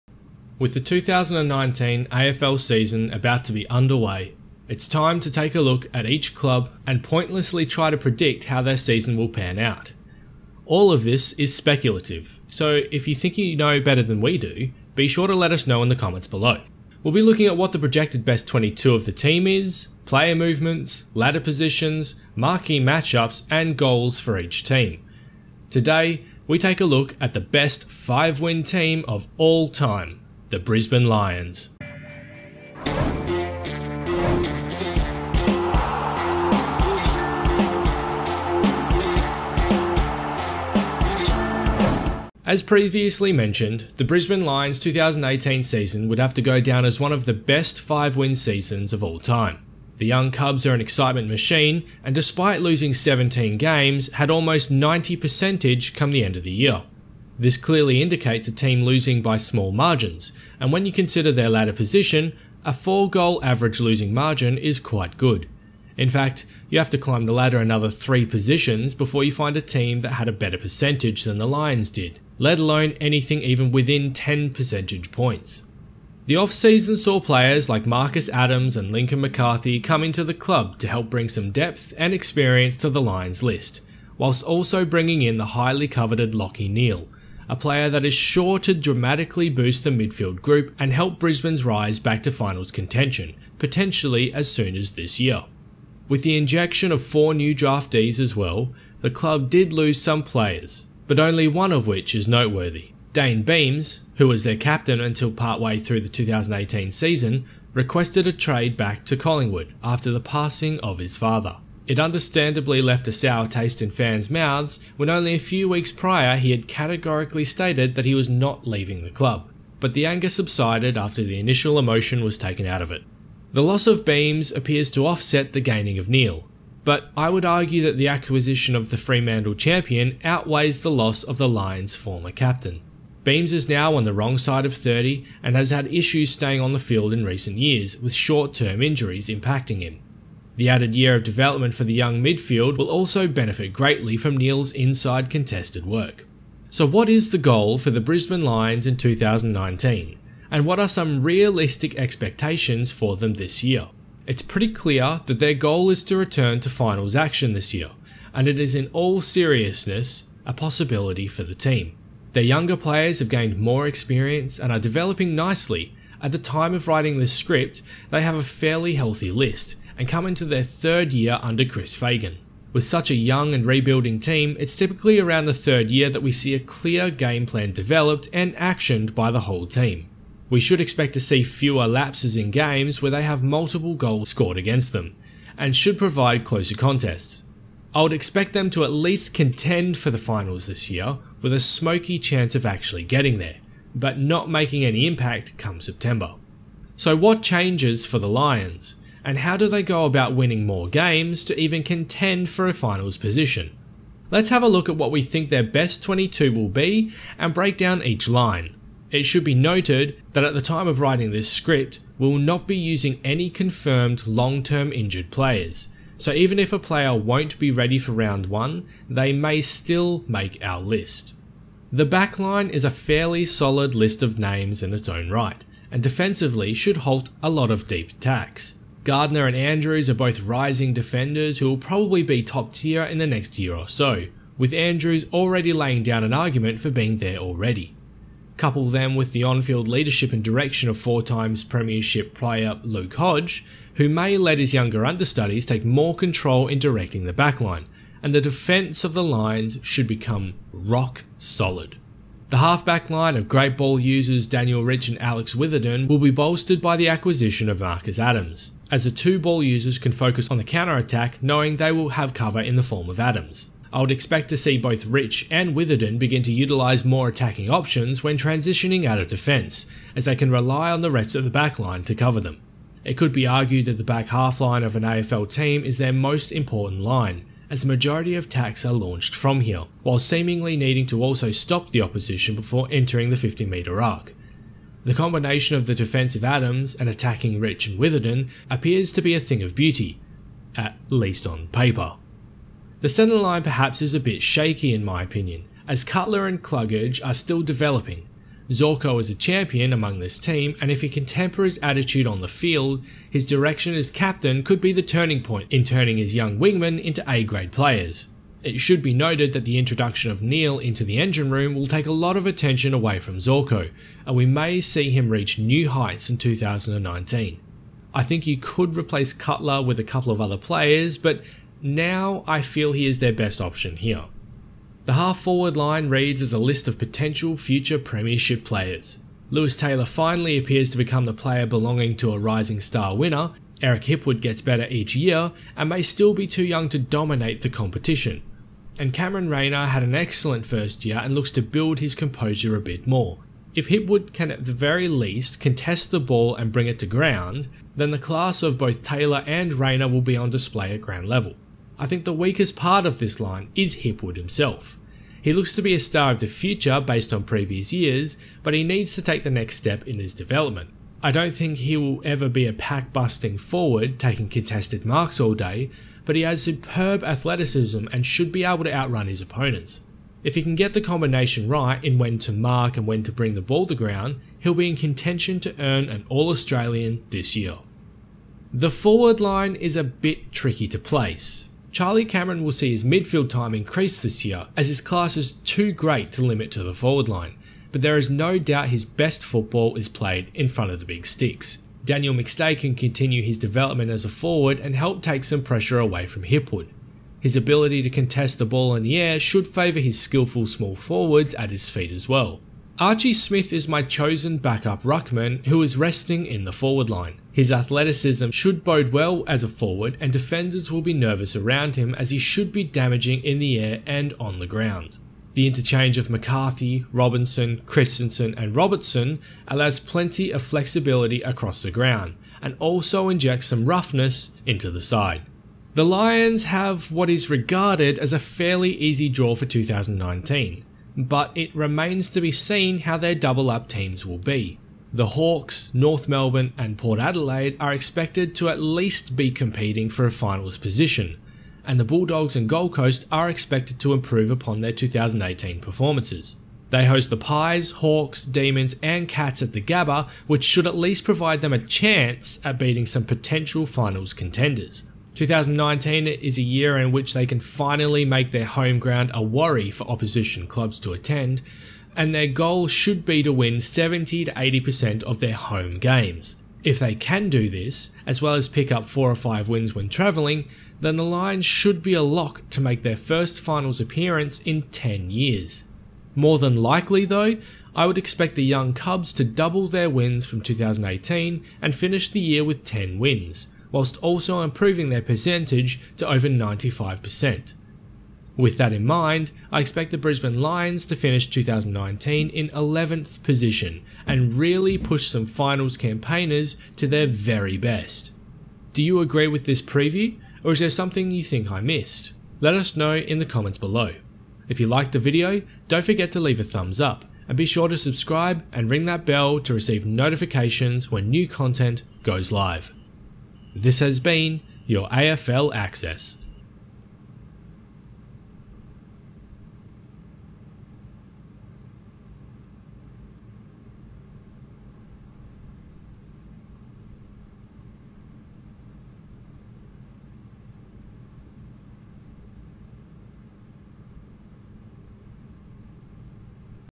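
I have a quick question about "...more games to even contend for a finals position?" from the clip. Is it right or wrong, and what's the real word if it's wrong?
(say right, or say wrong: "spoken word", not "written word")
right.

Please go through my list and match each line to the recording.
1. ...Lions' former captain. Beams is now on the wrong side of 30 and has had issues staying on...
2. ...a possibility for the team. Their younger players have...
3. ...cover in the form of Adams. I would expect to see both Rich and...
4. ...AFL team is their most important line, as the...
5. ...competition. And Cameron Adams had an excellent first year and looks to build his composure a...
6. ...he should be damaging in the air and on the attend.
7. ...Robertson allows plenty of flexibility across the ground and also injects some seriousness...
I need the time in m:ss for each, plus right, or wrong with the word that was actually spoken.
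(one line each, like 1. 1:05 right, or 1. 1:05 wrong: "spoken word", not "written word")
1. 2:11 right
2. 2:40 right
3. 4:22 right
4. 4:35 right
5. 5:37 wrong: "Rayner", not "Adams"
6. 6:52 wrong: "ground", not "attend"
7. 6:58 wrong: "roughness", not "seriousness".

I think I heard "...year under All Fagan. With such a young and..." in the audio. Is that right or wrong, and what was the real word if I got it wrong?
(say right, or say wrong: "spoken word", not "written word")
wrong: "Chris", not "All".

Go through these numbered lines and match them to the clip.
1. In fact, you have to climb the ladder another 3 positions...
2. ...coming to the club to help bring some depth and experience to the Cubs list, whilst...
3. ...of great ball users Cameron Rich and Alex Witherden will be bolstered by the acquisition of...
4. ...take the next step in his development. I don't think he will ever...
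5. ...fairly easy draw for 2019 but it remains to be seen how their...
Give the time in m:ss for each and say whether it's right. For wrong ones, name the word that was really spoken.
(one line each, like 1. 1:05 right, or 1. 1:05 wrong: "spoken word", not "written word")
1. 1:05 right
2. 1:19 wrong: "Lions", not "Cubs"
3. 4:13 wrong: "Daniel", not "Cameron"
4. 5:59 right
5. 7:08 right.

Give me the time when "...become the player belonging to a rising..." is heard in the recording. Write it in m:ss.
5:30.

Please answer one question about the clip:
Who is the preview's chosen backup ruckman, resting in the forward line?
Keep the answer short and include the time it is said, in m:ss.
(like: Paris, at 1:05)
Archie Smith, at 6:42.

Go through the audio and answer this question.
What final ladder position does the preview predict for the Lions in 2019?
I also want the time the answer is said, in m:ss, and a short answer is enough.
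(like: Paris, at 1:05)
11th, at 8:12.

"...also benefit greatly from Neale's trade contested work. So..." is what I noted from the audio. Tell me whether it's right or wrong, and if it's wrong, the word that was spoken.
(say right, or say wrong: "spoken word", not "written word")
wrong: "inside", not "trade".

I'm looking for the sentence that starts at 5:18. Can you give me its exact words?
I think you could replace Cutler with a couple of other players, but now I feel he is their best option here.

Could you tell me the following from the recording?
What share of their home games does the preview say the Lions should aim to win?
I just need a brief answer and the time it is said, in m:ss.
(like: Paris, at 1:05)
70 to 80%, at 7:43.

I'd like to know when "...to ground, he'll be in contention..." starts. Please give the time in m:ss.
6:13.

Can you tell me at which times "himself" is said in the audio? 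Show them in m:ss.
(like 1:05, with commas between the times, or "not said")
5:54.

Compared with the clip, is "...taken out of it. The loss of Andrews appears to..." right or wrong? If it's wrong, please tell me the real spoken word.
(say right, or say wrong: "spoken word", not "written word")
wrong: "Beams", not "Andrews".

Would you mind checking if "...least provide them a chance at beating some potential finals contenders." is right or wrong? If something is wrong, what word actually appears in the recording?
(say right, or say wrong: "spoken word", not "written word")
right.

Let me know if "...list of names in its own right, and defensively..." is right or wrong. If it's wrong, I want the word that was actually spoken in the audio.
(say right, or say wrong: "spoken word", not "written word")
right.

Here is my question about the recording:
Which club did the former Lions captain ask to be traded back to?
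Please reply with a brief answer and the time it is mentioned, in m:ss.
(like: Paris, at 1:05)
Collingwood, at 1:49.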